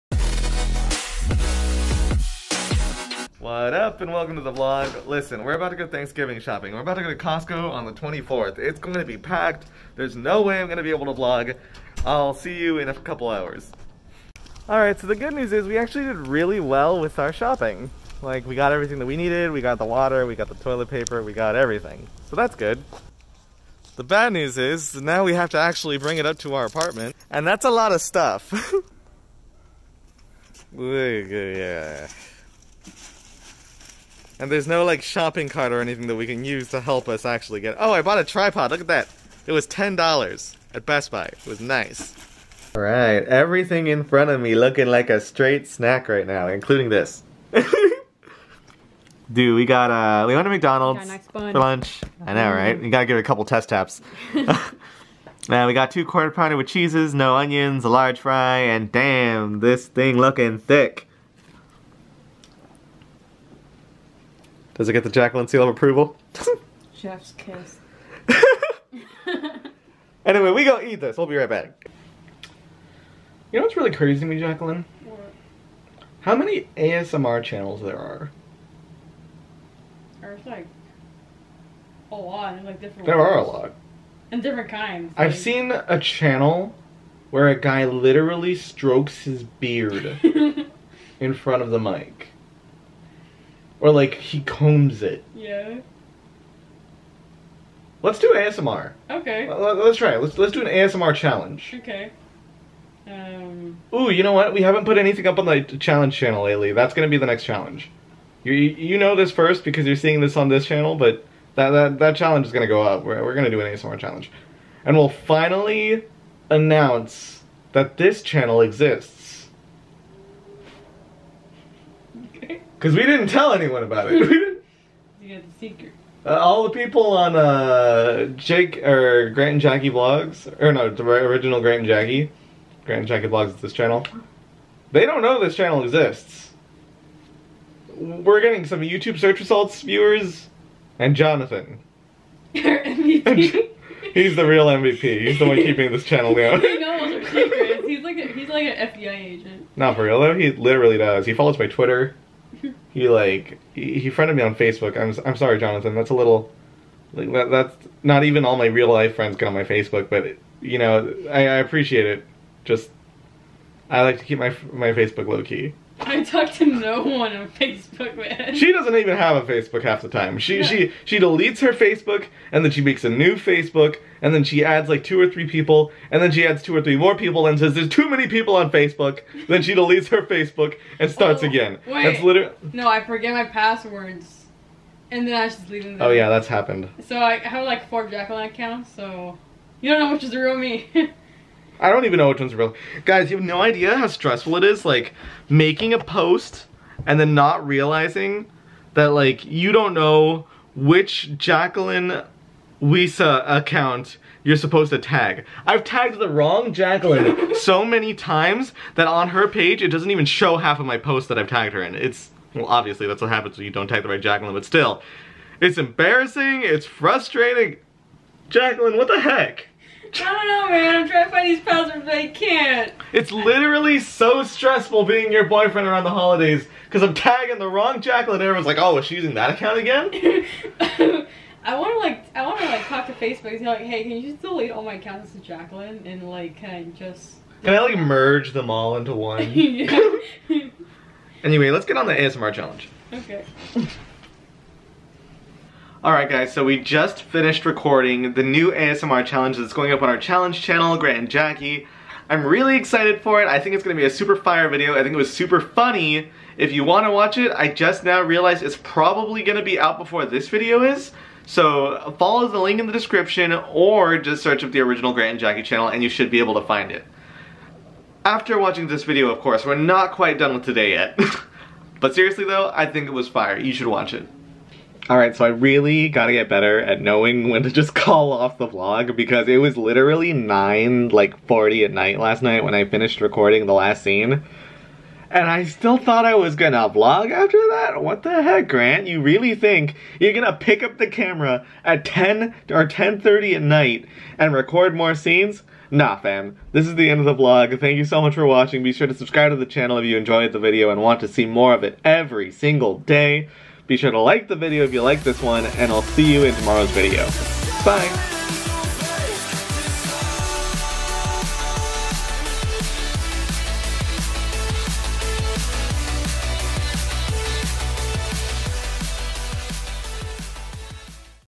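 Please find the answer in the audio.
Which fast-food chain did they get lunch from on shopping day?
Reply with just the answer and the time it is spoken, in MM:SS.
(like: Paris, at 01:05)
McDonald's, at 00:50.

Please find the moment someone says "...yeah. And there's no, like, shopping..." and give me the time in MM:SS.
00:30.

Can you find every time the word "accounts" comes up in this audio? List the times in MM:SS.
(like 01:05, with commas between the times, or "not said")
03:08, 03:23, 03:49, 03:54.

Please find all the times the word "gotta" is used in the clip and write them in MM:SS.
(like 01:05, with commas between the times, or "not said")
00:52, 04:36.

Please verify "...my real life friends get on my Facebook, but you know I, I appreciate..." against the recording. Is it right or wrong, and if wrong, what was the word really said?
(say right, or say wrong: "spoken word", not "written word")
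right.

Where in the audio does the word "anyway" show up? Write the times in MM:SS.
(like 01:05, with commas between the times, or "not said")
01:10, 04:01.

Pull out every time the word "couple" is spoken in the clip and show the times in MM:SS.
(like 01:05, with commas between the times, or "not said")
00:12, 00:53.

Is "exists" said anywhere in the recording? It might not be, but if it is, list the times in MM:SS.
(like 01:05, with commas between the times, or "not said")
01:58, 02:15.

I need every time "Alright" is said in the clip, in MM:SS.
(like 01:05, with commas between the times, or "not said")
00:14, 00:42, 04:06.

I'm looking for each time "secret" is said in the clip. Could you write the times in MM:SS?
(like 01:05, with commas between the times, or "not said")
02:05, 02:27.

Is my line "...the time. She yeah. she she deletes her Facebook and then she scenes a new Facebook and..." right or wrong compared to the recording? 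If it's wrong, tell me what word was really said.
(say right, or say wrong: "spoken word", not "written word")
wrong: "makes", not "scenes".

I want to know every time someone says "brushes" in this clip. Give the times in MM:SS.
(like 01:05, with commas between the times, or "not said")
not said.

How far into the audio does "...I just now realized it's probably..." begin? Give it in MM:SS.
04:17.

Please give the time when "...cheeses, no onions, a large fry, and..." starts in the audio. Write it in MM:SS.
00:56.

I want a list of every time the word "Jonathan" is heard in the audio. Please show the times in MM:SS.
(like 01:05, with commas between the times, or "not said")
02:21, 02:35.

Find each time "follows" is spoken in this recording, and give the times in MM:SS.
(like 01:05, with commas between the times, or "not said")
02:31, 04:22.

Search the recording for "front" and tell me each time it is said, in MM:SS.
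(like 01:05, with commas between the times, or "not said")
00:44, 01:31.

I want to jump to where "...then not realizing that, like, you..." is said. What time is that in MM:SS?
03:17.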